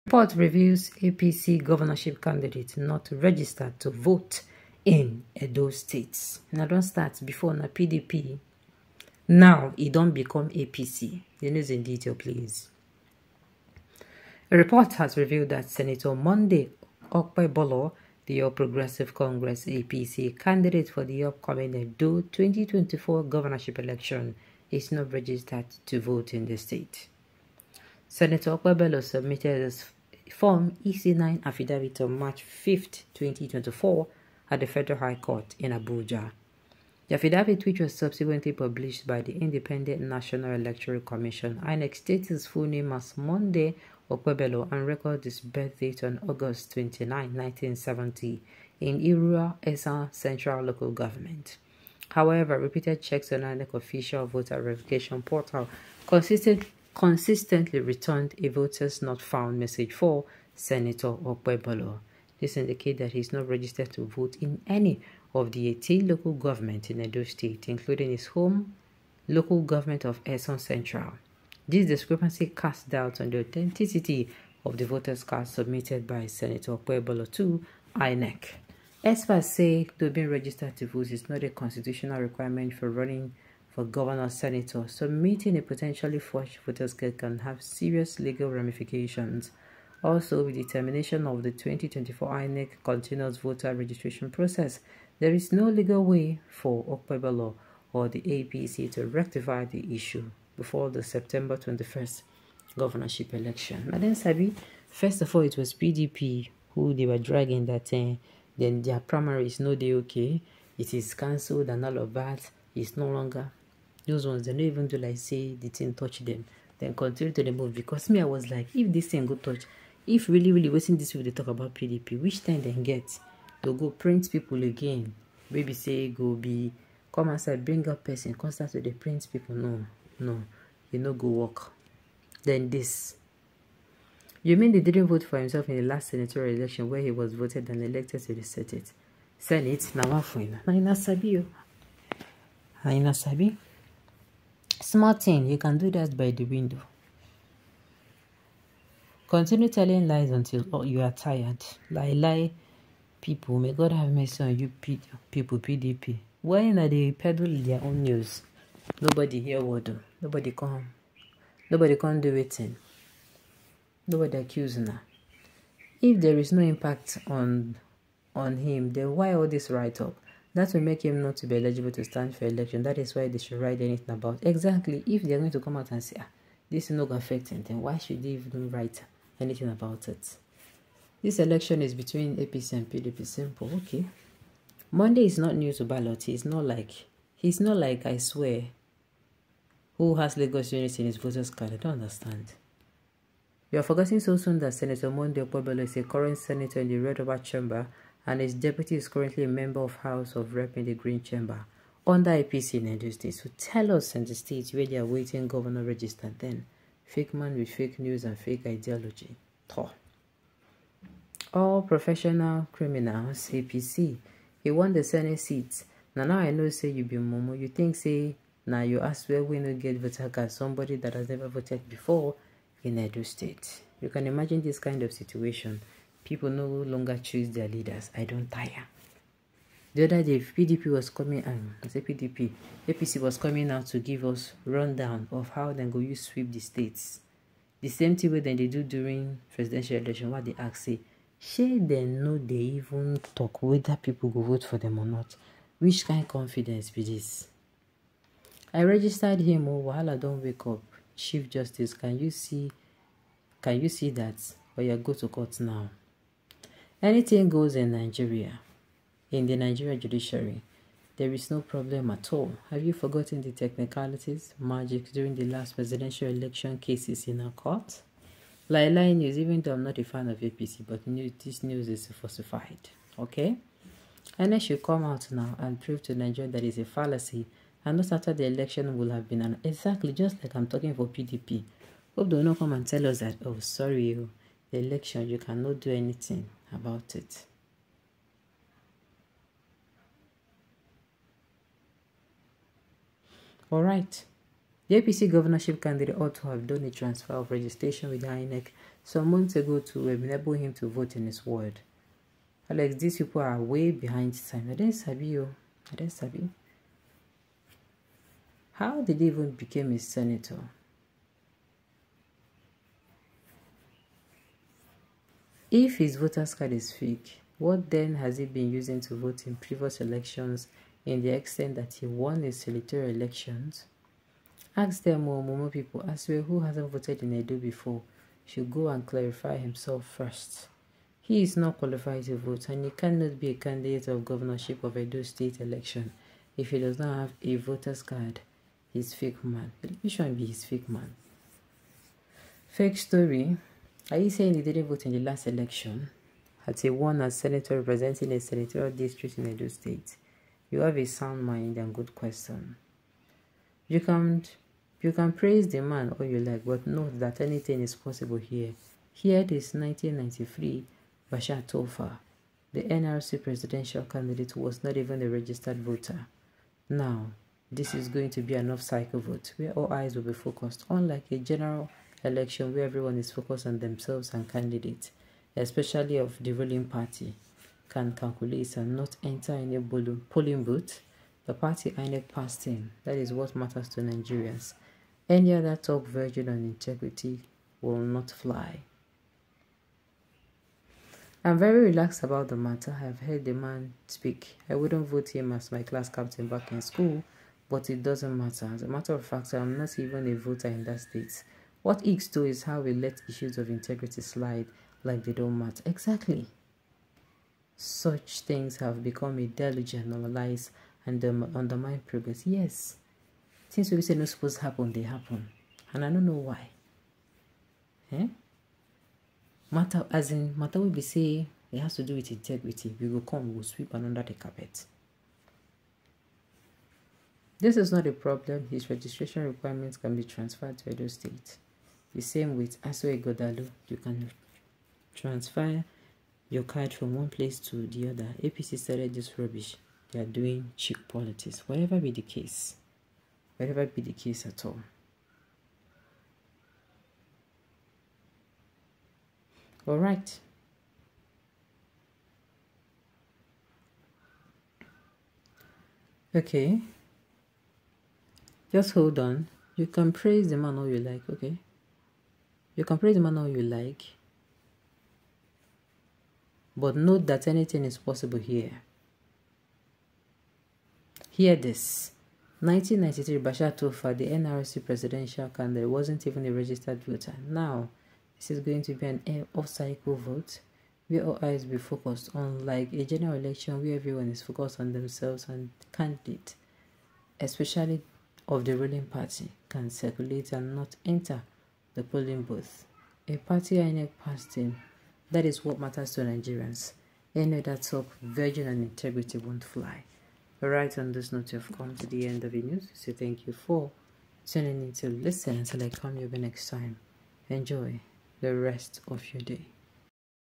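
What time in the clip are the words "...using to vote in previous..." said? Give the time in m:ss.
5:18.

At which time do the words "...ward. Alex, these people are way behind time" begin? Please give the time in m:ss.
5:01.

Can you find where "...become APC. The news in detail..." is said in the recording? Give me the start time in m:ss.
0:10.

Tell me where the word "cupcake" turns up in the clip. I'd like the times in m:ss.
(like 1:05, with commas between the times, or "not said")
not said.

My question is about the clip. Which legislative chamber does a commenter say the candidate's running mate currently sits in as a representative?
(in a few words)
Green Chamber.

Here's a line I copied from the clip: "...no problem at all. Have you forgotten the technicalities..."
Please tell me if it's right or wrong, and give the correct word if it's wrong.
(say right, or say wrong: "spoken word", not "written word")
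right.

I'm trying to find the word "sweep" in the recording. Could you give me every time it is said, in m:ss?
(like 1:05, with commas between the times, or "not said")
3:56, 7:03.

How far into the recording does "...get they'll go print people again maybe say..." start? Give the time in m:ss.
2:02.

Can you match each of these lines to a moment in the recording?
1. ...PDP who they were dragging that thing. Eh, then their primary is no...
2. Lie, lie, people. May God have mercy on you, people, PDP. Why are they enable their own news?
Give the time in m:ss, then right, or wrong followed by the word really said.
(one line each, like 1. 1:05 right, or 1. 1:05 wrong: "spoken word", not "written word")
1. 1:45 right
2. 2:31 wrong: "peddle", not "enable".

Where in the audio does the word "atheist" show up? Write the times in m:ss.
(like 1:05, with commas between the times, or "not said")
not said.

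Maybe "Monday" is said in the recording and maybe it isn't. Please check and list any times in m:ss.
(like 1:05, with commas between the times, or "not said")
0:16, 0:43, 3:04, 3:15.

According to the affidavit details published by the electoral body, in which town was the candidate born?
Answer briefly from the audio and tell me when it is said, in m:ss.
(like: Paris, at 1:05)
Irrua, at 0:48.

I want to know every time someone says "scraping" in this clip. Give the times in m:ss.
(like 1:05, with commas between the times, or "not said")
not said.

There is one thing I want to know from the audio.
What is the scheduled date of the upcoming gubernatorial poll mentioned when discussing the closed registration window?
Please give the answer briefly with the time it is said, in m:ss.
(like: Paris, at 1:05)
September 21st, at 1:41.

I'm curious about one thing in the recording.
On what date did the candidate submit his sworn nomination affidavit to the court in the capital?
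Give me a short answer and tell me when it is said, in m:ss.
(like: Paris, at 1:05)
March 5, 2024, at 0:32.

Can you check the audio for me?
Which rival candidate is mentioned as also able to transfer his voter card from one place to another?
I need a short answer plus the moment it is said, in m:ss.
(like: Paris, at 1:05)
Asue Ighodalo, at 7:12.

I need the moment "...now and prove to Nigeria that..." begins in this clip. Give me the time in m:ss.
4:35.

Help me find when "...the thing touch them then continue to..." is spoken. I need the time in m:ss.
1:55.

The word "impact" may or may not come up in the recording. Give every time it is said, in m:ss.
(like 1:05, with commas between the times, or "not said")
2:46.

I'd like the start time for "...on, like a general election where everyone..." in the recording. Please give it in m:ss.
8:02.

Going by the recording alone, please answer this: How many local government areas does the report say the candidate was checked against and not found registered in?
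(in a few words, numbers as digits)
18.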